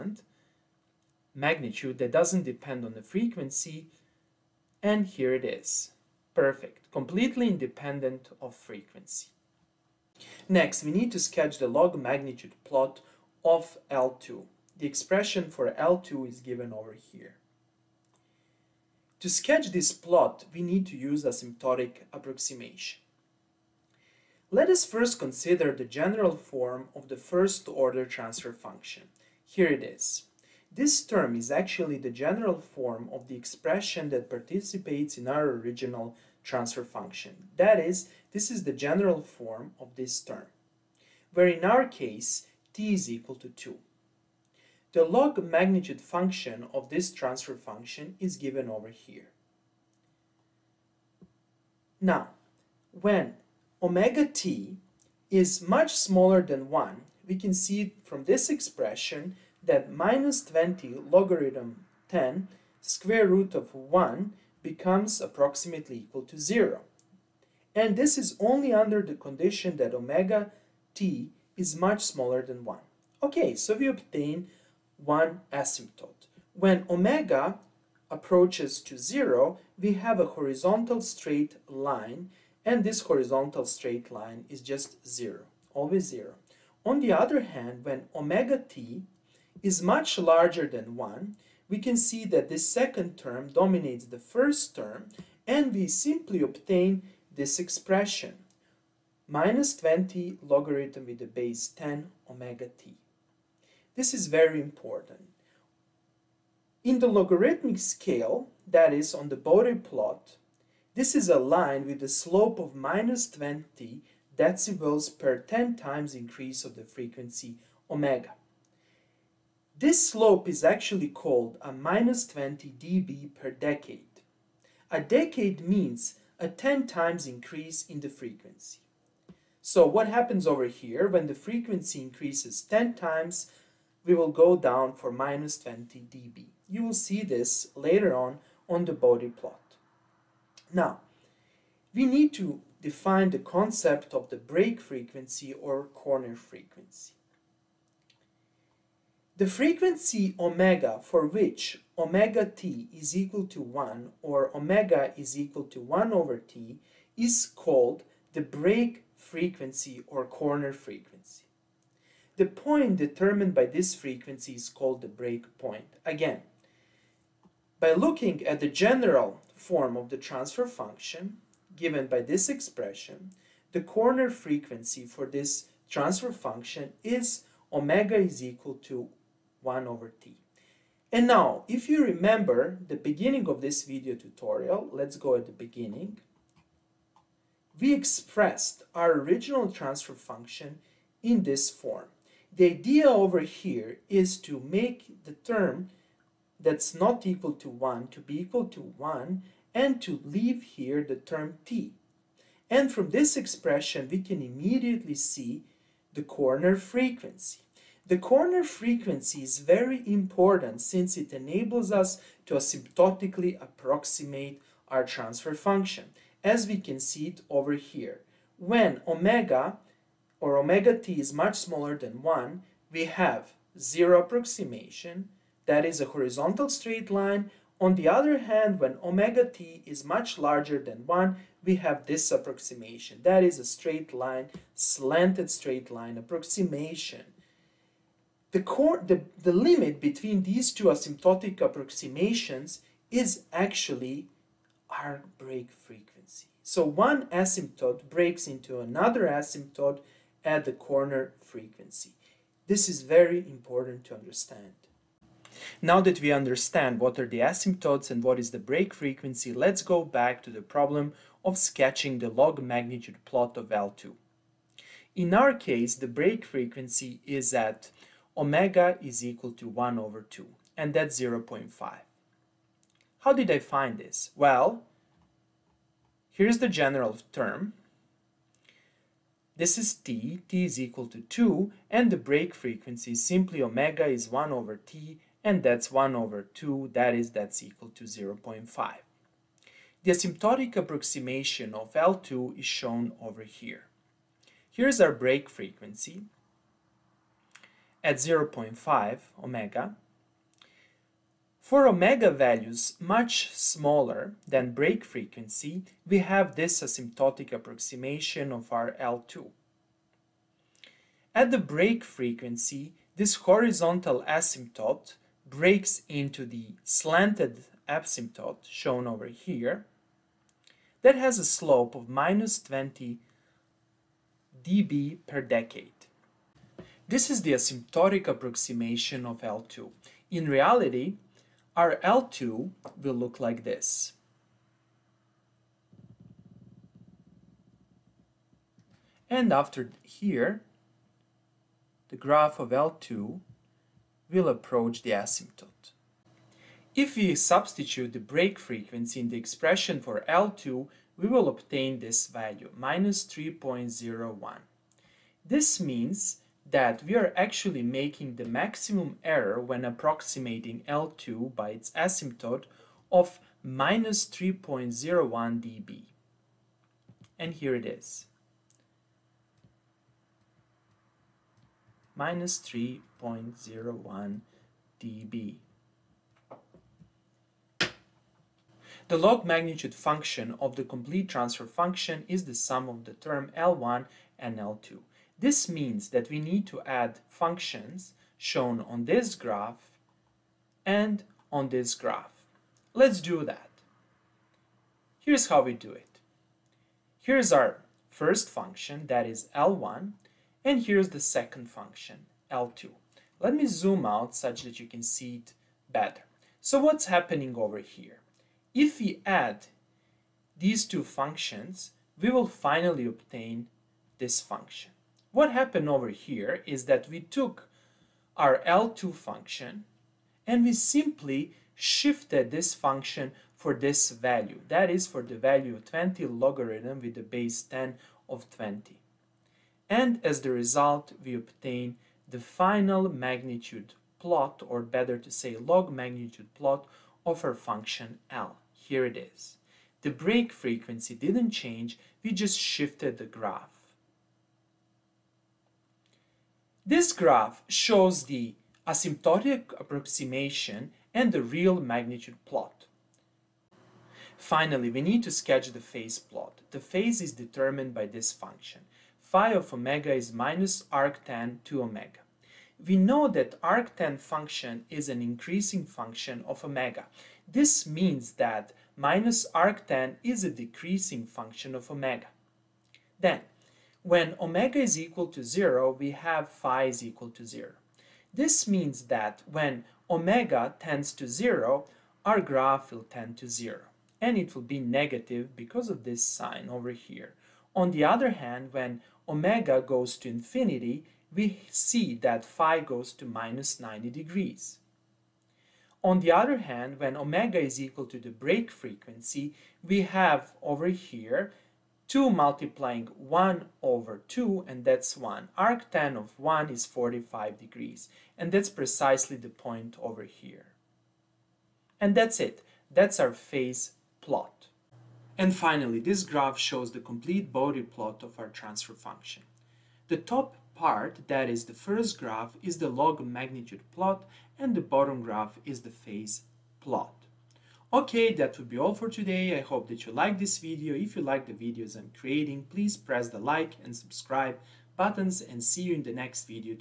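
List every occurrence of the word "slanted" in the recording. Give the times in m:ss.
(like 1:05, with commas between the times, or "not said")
3:54, 5:16.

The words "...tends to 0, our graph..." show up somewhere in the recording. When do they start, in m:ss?
8:00.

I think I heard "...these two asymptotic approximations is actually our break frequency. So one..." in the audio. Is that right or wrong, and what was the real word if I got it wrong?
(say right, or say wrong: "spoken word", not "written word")
right.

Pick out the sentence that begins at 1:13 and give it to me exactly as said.
Okay, so we obtain one asymptote.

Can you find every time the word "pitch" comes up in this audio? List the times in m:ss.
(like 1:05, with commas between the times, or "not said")
not said.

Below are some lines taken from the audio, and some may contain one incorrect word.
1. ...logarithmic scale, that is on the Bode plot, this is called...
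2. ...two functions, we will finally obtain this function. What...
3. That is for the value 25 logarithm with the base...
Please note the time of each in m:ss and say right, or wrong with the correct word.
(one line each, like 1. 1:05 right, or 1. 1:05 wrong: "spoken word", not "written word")
1. 1:47 wrong: "aligned", not "called"
2. 6:50 right
3. 7:04 wrong: "20", not "25".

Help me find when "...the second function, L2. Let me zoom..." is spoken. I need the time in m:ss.
6:41.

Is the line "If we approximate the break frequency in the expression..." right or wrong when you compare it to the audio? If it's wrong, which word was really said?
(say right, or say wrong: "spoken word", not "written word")
wrong: "substitute", not "approximate".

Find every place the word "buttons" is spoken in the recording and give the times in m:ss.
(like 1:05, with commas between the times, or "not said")
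8:54.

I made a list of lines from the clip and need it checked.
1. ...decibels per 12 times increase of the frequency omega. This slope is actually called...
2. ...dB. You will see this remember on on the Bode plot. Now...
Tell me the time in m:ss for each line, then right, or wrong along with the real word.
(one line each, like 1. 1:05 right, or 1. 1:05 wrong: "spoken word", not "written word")
1. 1:54 wrong: "10", not "12"
2. 2:15 wrong: "later", not "remember".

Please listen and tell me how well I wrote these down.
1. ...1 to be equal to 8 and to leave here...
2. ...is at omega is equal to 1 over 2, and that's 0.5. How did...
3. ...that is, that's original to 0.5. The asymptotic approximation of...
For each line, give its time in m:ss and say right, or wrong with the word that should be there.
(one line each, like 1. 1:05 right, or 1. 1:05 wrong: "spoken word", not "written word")
1. 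3:17 wrong: "1", not "8"
2. 4:27 right
3. 4:46 wrong: "equal", not "original".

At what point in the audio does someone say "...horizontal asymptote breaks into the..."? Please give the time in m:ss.
5:13.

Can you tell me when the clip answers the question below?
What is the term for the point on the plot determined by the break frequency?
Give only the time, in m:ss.
2:45.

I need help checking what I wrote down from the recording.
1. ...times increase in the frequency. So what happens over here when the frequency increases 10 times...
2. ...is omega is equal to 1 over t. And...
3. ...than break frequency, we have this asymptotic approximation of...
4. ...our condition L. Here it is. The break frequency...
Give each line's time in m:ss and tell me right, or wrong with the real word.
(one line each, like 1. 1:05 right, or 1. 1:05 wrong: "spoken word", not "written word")
1. 2:06 right
2. 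2:57 right
3. 5:04 right
4. 7:17 wrong: "function", not "condition".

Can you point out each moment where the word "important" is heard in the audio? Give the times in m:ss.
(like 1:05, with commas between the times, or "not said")
1:44, 3:30, 4:13.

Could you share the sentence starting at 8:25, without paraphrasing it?
Arctan of 1 is 45 degrees and that's precisely the point over here.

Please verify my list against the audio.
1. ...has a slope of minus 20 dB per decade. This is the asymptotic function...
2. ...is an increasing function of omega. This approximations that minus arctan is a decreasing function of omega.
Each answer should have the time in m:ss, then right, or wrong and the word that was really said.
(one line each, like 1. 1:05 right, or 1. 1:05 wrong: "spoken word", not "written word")
1. 5:21 wrong: "approximation", not "function"
2. 7:44 wrong: "means", not "approximations".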